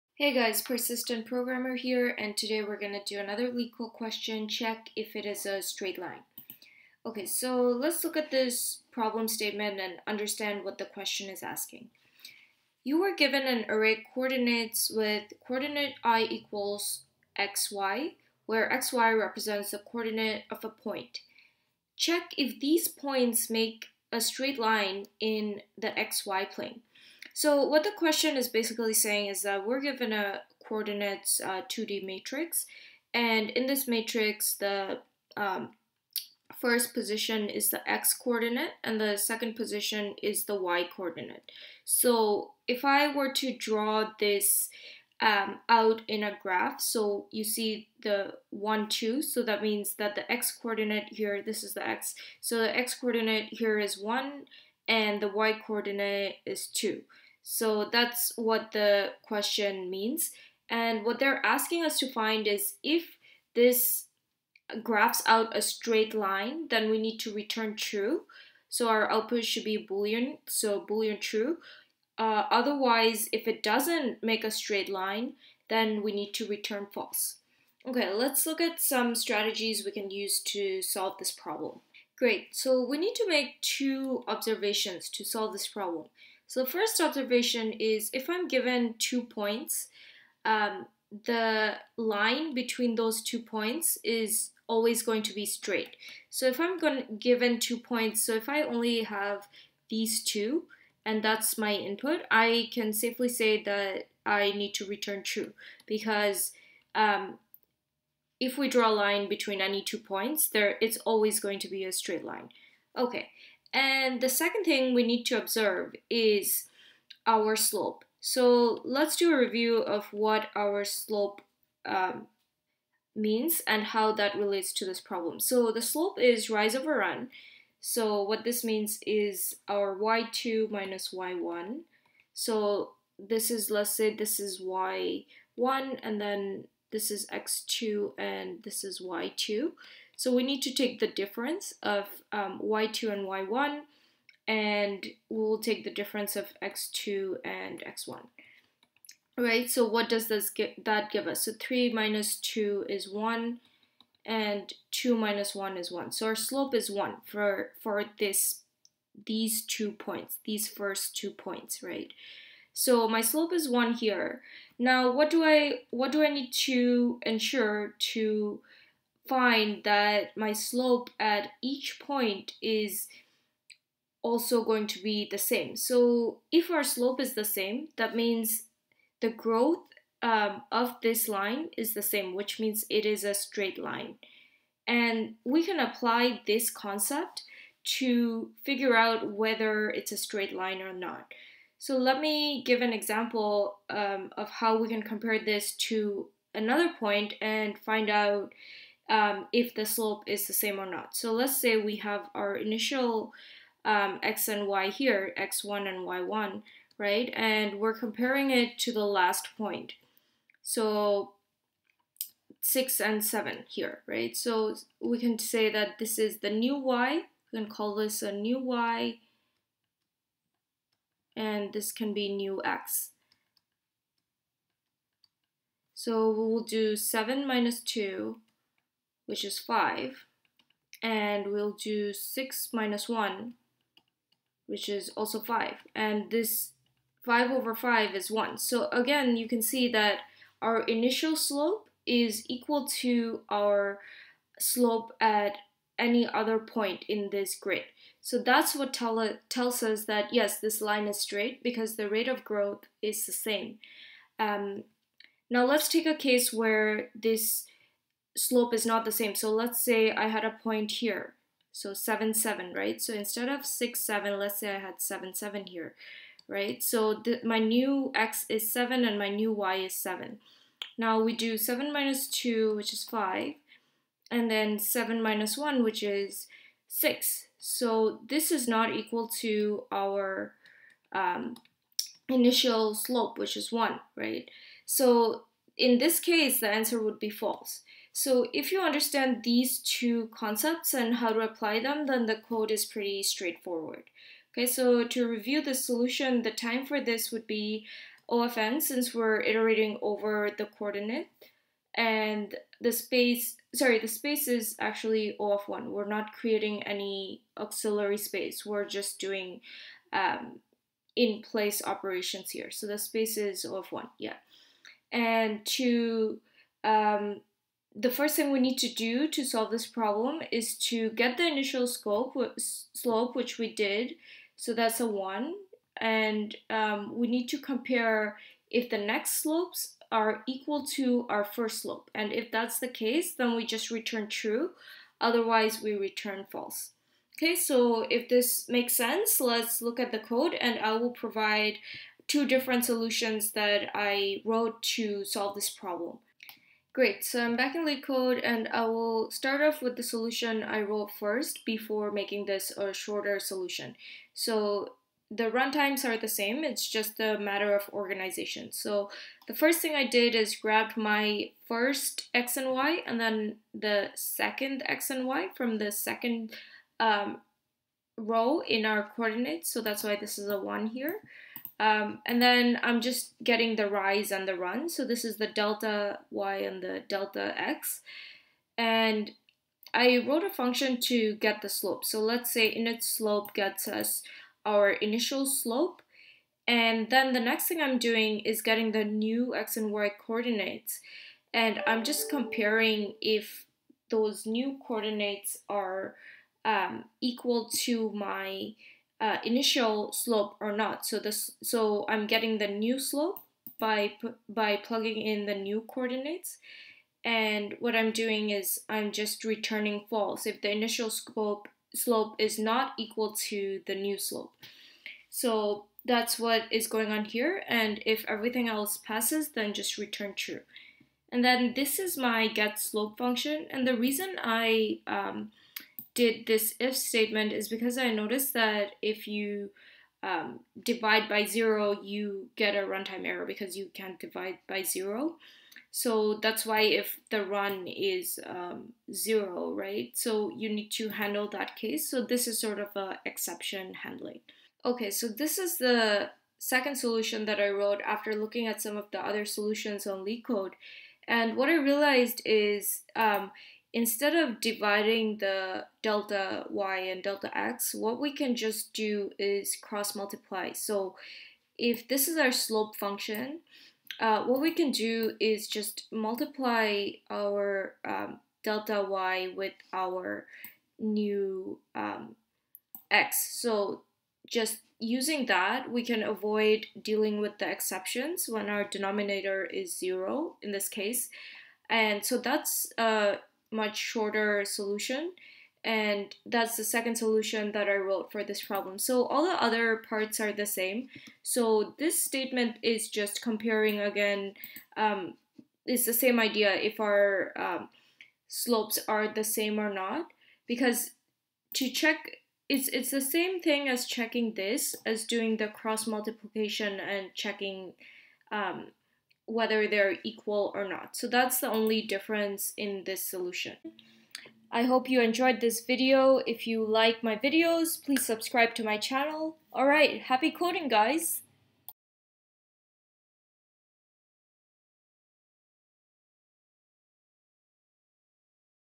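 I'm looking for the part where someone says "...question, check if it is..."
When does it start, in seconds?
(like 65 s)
3 s.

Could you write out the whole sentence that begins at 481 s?
And so that's uh, much shorter solution and that's the second solution that I wrote for this problem.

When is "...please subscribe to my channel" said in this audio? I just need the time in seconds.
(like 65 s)
518 s.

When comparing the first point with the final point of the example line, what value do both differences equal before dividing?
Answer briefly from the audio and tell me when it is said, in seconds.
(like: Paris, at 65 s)
5, at 234 s.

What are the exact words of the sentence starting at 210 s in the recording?
So 6 and 7 here, right?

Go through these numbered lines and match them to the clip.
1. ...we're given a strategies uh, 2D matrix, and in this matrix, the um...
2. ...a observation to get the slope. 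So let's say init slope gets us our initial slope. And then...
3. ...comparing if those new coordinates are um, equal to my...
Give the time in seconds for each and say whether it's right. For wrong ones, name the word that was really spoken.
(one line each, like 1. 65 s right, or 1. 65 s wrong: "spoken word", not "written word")
1. 29 s wrong: "coordinates", not "strategies"
2. 380 s wrong: "function", not "observation"
3. 392 s right.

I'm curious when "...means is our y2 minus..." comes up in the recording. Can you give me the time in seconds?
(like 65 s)
128 s.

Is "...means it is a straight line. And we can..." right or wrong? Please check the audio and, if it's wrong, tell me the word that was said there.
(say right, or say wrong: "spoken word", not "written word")
right.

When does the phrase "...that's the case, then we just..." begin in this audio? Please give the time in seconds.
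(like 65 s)
332 s.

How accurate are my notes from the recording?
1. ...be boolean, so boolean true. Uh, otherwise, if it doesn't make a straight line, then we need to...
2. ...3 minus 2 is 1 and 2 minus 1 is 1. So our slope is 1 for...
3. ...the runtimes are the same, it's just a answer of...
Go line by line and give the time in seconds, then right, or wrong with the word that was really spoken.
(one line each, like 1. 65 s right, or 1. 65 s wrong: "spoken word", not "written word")
1. 69 s right
2. 151 s right
3. 355 s wrong: "matter", not "answer".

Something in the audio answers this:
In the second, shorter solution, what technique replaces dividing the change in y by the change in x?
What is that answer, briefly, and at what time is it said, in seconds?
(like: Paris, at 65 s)
cross multiply, at 459 s.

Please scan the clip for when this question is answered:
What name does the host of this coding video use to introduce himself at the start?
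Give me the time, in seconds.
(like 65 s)
0 s.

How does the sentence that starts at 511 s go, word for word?
So that's the only difference in this solution.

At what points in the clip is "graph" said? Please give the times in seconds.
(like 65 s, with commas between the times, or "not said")
46 s, 64 s.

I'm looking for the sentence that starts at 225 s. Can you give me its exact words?
So we'll do 7 minus 2 which is 5.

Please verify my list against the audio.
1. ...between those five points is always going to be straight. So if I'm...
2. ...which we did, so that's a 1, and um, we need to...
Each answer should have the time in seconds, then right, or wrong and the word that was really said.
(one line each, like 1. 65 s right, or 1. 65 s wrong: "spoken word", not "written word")
1. 92 s wrong: "two", not "five"
2. 323 s right.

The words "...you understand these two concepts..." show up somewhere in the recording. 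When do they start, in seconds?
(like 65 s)
288 s.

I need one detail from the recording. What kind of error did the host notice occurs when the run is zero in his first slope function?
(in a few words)
runtime error.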